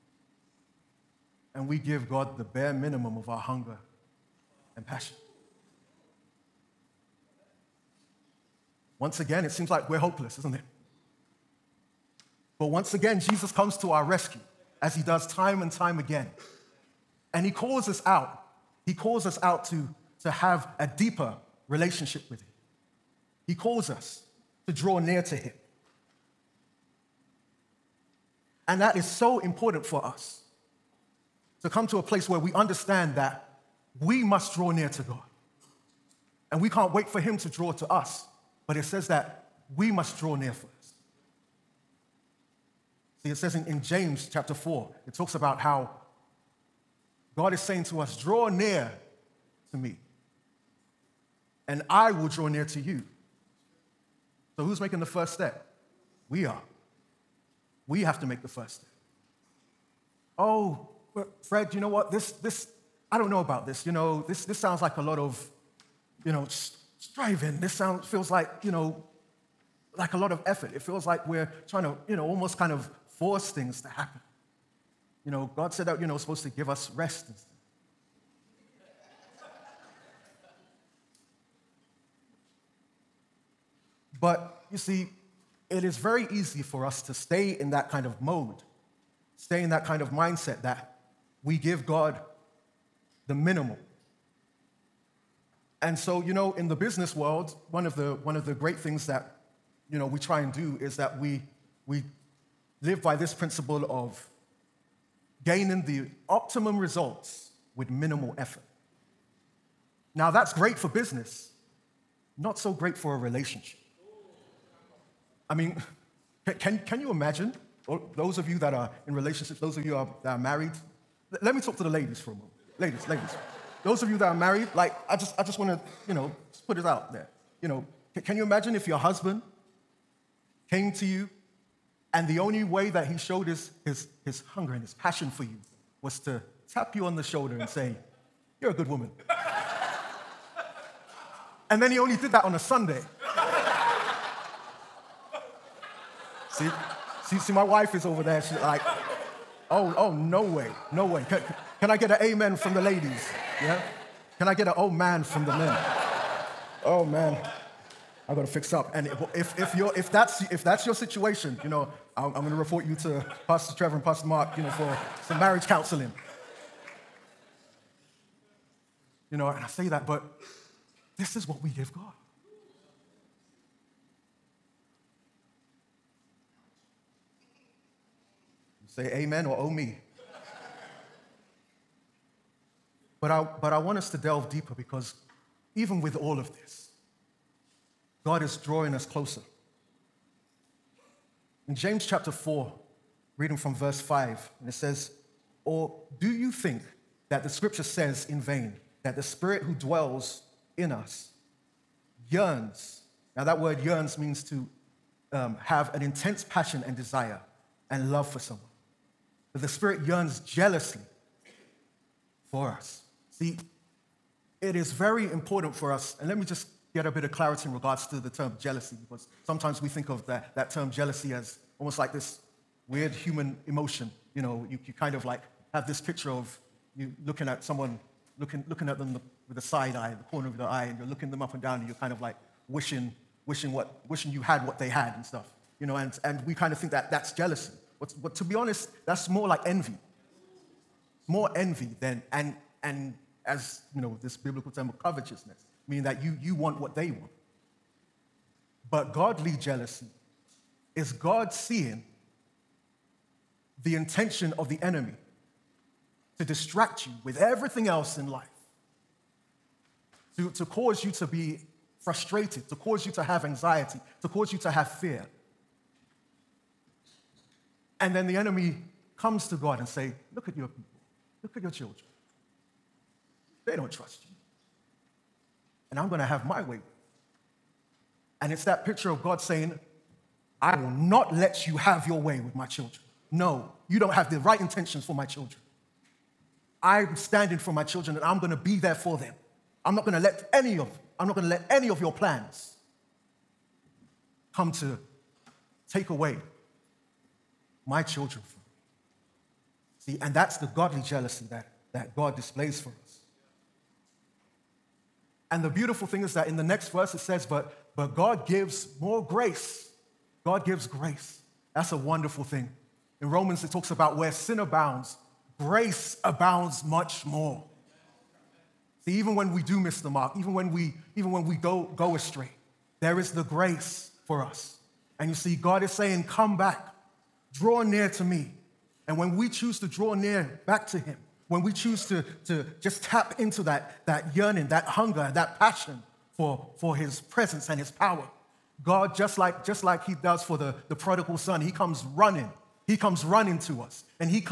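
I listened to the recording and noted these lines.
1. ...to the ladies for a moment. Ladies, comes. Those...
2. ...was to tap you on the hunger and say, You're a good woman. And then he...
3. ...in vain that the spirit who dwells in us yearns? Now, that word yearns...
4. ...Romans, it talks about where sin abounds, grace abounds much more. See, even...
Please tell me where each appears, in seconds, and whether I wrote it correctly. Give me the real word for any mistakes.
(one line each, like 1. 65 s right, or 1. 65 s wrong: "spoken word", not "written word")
1. 121 s wrong: "ladies", not "comes"
2. 136 s wrong: "shoulder", not "hunger"
3. 198 s right
4. 313 s right.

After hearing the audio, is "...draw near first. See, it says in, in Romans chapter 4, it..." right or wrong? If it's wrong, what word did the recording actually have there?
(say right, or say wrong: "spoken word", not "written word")
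wrong: "James", not "Romans".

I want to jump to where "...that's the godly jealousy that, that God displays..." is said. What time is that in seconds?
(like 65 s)
300 s.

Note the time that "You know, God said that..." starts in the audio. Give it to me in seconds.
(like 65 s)
75 s.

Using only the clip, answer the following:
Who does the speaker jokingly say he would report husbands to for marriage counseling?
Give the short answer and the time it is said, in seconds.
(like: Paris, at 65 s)
Pastor Trevor and Pastor Mark, at 163 s.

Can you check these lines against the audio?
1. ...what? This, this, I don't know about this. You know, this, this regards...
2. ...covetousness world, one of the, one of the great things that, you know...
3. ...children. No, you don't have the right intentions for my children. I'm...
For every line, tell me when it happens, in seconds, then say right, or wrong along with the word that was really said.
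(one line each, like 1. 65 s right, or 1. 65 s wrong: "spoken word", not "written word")
1. 61 s wrong: "sounds", not "regards"
2. 96 s wrong: "business", not "covetousness"
3. 282 s right.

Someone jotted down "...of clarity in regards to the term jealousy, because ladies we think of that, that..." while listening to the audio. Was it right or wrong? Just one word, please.
wrong.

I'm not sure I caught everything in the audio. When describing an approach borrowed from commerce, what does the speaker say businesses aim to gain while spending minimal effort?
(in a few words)
optimum results.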